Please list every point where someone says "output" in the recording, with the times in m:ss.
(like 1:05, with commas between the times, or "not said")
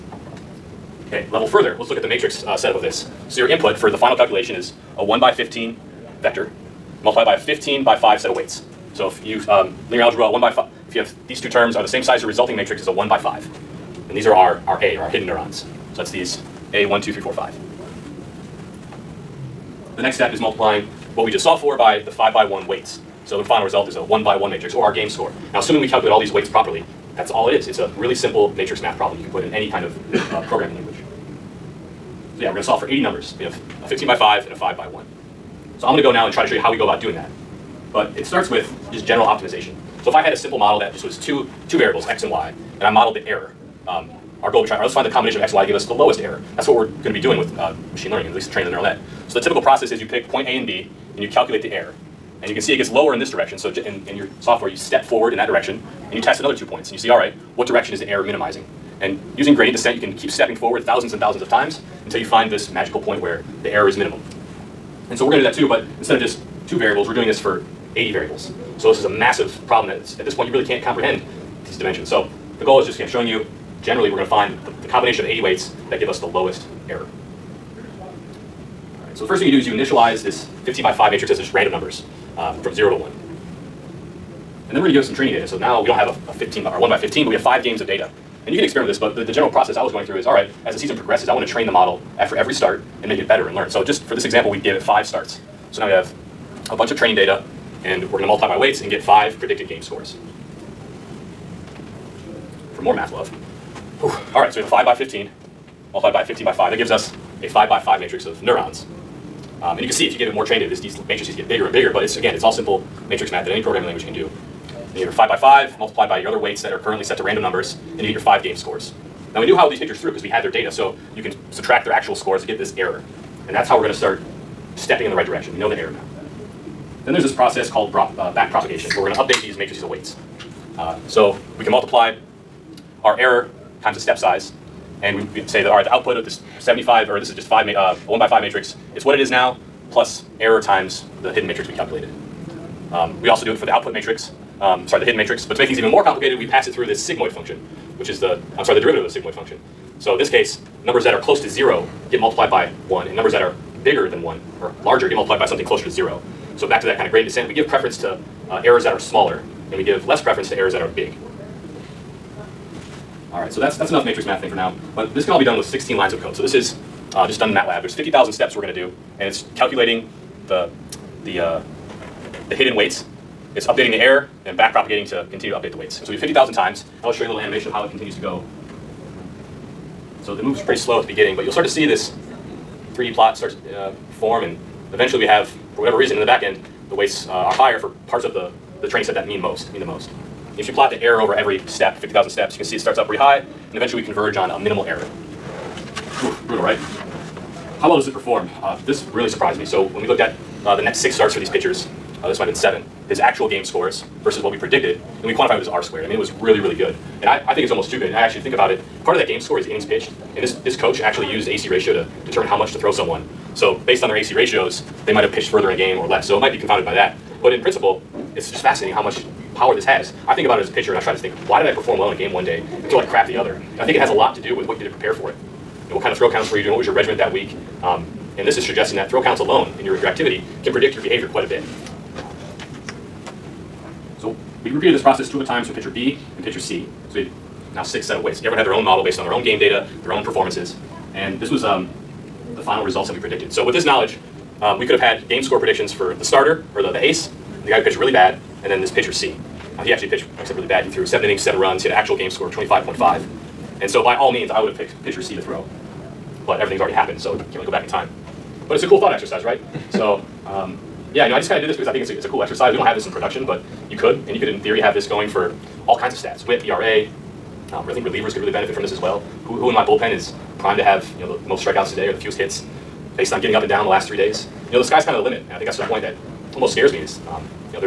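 2:15, 2:23.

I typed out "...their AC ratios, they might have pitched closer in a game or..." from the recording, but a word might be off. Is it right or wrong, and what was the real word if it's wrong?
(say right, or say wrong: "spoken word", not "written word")
wrong: "further", not "closer".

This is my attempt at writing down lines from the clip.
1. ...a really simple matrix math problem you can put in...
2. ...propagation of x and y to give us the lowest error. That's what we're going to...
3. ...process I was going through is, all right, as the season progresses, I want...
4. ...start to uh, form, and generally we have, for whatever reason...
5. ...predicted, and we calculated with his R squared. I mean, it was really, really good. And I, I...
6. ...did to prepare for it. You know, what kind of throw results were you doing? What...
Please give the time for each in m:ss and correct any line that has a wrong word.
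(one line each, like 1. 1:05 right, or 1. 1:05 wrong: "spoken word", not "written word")
1. 0:27 right
2. 0:45 wrong: "combination", not "propagation"
3. 1:29 right
4. 3:03 wrong: "eventually", not "generally"
5. 3:24 wrong: "quantified", not "calculated"
6. 3:44 wrong: "counts", not "results".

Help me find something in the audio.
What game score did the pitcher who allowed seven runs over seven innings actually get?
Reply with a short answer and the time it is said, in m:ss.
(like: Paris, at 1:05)
25.5, at 4:12.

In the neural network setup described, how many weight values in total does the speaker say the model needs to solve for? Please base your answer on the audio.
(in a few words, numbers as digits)
80.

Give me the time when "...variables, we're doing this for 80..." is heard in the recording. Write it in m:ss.
1:06.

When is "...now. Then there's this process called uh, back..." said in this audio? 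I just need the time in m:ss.
2:05.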